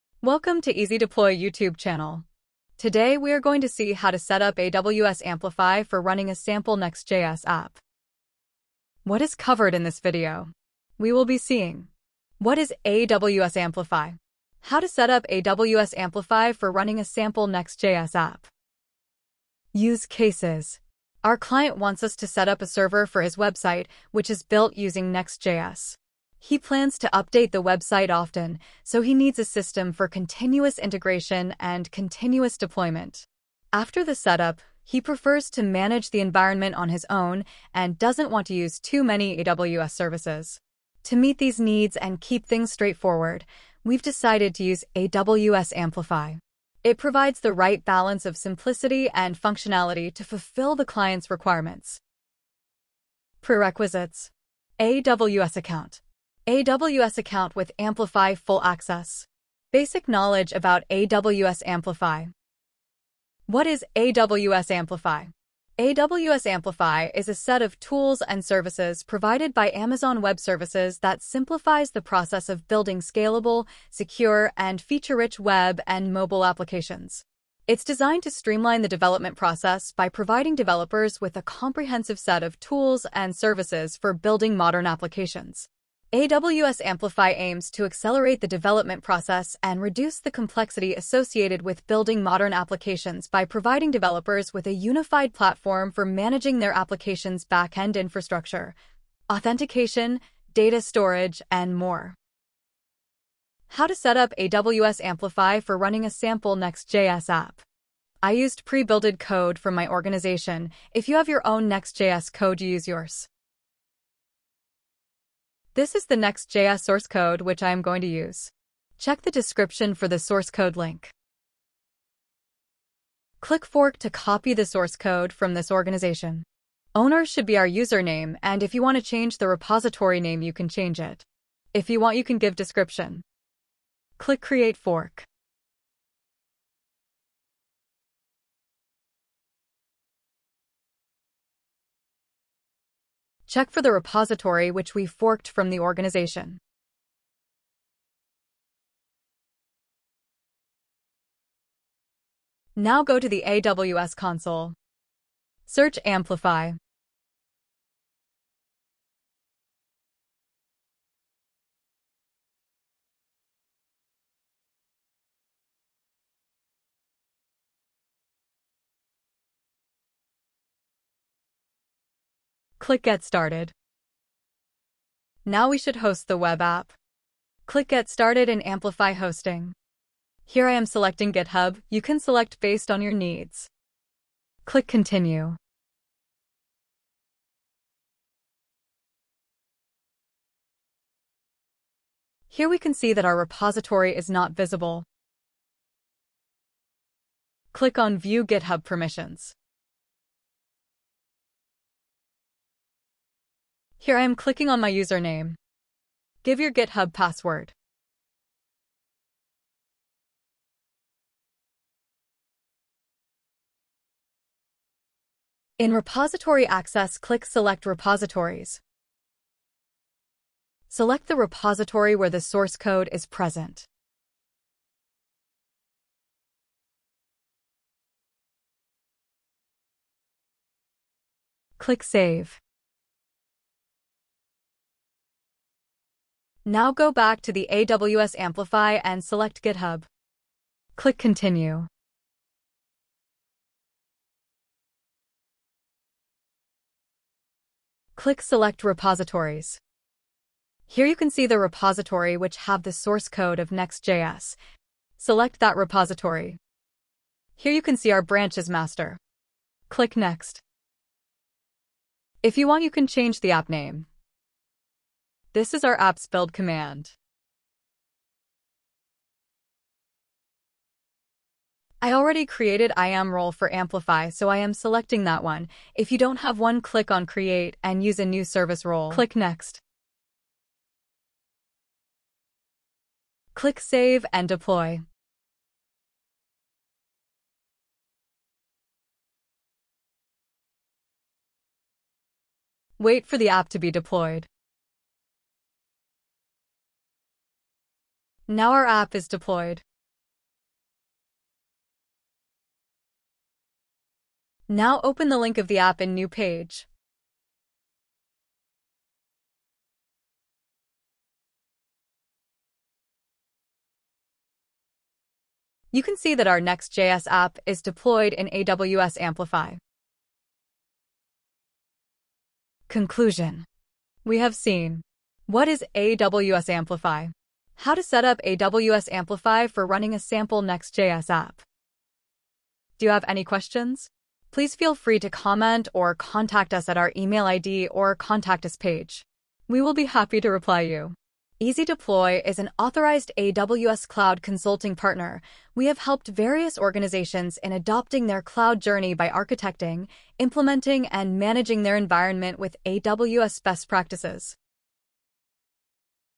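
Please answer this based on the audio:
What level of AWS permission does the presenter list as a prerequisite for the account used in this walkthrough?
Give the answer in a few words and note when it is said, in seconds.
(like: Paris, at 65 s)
Amplify Full Access, at 57 s.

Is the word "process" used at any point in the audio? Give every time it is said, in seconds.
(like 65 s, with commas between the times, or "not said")
72 s, 79 s, 89 s.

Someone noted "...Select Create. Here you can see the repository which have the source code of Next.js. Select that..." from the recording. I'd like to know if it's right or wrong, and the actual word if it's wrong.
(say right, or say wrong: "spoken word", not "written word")
wrong: "Repositories", not "Create".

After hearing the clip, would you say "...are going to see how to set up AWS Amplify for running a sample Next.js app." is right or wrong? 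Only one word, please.
right.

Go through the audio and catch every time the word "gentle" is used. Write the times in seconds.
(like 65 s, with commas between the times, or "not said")
not said.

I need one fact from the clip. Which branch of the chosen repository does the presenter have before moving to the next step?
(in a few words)
master.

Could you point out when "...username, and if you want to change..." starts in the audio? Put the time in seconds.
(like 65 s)
127 s.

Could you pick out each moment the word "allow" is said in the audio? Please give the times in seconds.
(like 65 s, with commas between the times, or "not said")
not said.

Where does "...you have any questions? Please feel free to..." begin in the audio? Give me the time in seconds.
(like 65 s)
333 s.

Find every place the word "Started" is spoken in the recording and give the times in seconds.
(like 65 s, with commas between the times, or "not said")
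173 s, 178 s.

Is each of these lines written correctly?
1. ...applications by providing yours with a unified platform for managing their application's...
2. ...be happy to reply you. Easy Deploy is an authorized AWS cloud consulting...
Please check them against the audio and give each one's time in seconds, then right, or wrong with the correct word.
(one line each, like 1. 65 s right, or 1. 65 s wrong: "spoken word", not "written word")
1. 92 s wrong: "developers", not "yours"
2. 339 s right.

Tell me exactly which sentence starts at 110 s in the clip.
If you have your own Next.js code, use yours.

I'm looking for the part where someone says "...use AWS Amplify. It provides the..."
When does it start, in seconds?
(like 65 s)
44 s.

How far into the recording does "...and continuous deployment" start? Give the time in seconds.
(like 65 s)
31 s.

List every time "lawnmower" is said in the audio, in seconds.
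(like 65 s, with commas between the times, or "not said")
not said.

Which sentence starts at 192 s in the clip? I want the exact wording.
Here we can see that our repository is not visible.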